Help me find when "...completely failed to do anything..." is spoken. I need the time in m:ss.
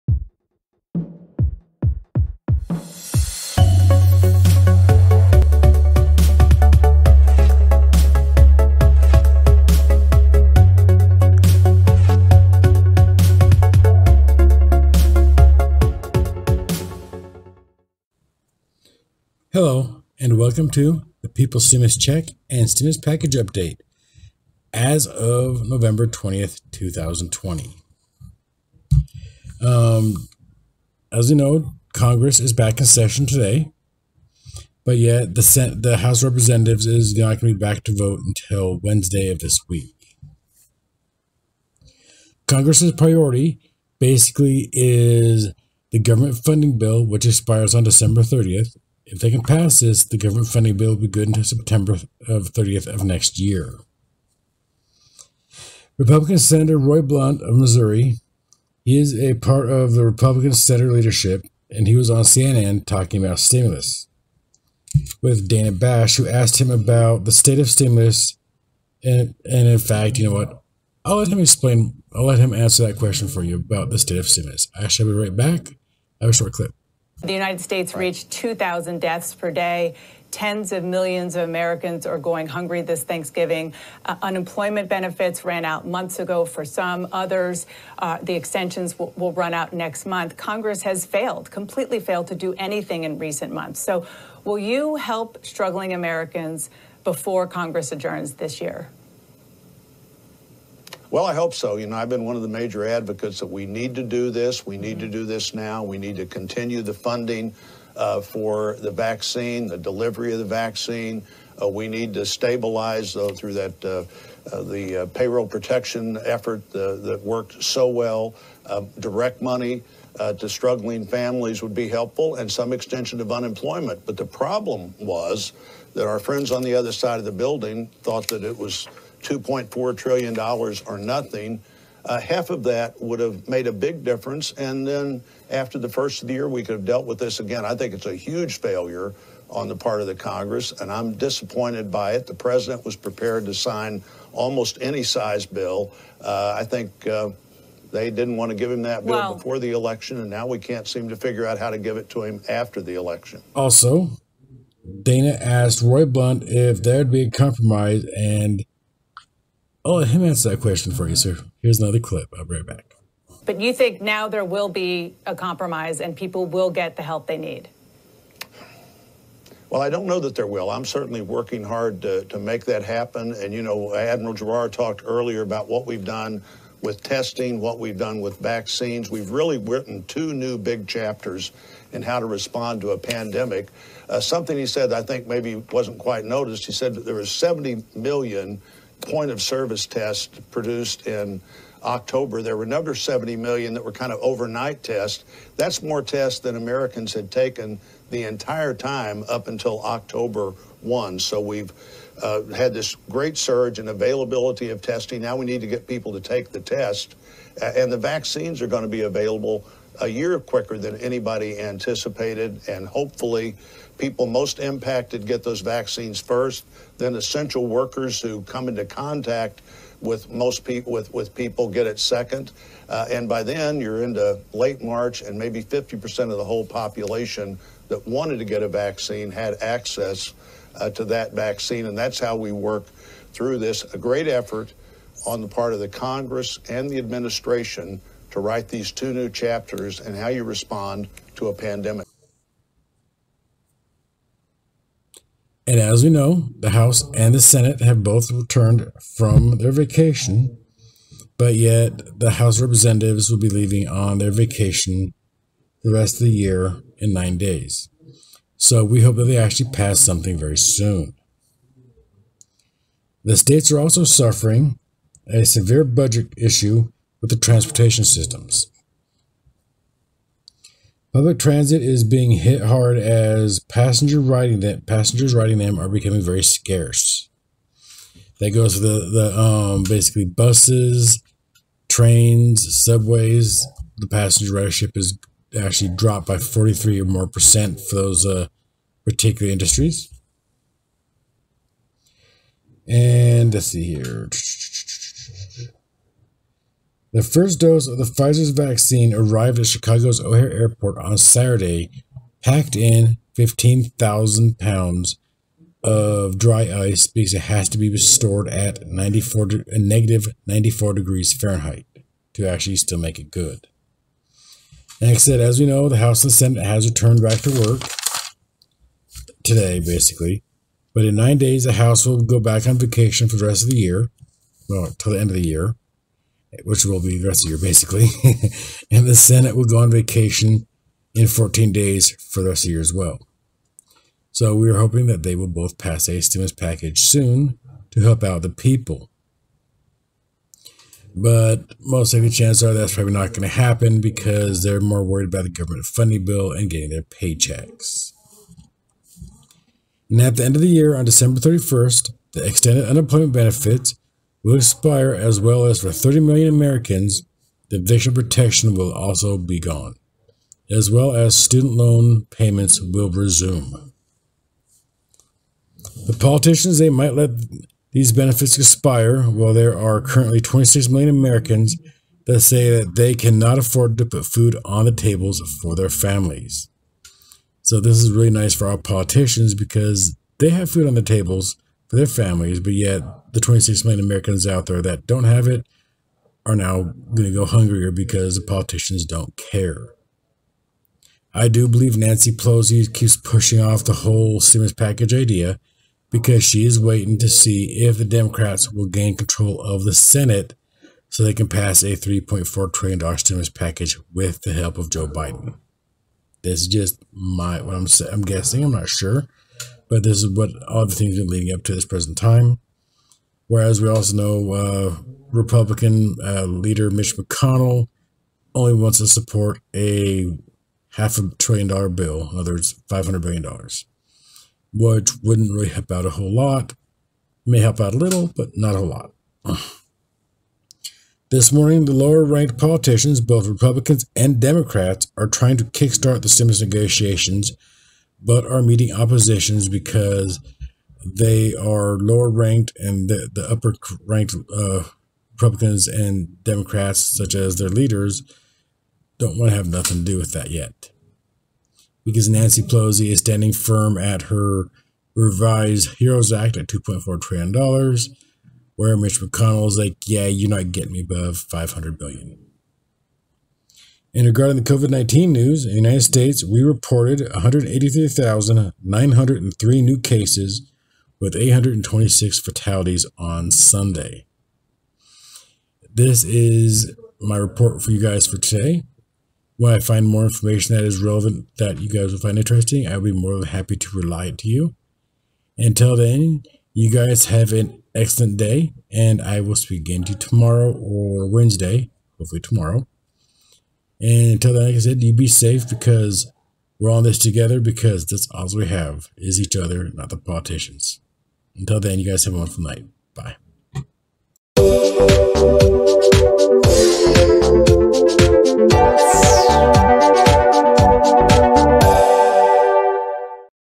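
1:31.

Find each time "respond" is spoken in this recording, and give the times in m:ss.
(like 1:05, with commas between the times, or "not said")
3:02, 4:00.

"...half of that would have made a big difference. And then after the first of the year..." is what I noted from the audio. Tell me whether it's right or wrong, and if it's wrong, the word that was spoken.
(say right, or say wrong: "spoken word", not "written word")
right.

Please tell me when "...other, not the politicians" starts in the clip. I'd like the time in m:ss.
8:19.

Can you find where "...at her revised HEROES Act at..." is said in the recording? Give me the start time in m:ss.
7:33.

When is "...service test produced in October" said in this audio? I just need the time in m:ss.
3:09.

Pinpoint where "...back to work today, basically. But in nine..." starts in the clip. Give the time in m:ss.
5:17.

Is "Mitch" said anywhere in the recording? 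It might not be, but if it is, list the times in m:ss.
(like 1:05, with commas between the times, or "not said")
6:56, 7:38.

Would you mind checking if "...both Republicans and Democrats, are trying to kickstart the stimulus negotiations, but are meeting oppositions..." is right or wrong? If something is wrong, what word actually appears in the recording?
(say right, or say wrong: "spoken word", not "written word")
right.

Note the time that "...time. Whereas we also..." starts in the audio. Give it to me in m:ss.
6:52.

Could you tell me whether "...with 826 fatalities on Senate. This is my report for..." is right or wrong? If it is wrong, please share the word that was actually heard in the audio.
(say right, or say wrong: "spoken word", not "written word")
wrong: "Sunday", not "Senate".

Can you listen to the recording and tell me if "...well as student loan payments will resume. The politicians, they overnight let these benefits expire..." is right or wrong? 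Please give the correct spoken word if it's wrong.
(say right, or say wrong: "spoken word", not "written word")
wrong: "might", not "overnight".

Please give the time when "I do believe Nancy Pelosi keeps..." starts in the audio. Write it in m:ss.
6:31.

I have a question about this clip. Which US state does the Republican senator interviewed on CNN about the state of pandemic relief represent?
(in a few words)
Missouri.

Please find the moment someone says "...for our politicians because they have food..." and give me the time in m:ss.
6:18.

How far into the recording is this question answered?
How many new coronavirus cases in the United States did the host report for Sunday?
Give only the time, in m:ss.
7:47.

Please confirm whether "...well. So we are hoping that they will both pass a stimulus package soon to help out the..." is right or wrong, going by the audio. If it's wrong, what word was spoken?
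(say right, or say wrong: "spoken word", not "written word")
right.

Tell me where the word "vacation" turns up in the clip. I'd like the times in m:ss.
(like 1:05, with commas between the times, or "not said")
4:09, 4:14, 5:22, 5:29.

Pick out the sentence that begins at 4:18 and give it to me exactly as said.
So we hope that they actually pass something very soon.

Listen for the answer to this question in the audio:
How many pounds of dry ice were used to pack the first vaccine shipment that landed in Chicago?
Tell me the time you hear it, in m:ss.
5:03.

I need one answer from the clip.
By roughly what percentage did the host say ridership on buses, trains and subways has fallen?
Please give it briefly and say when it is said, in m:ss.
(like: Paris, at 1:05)
43%, at 4:46.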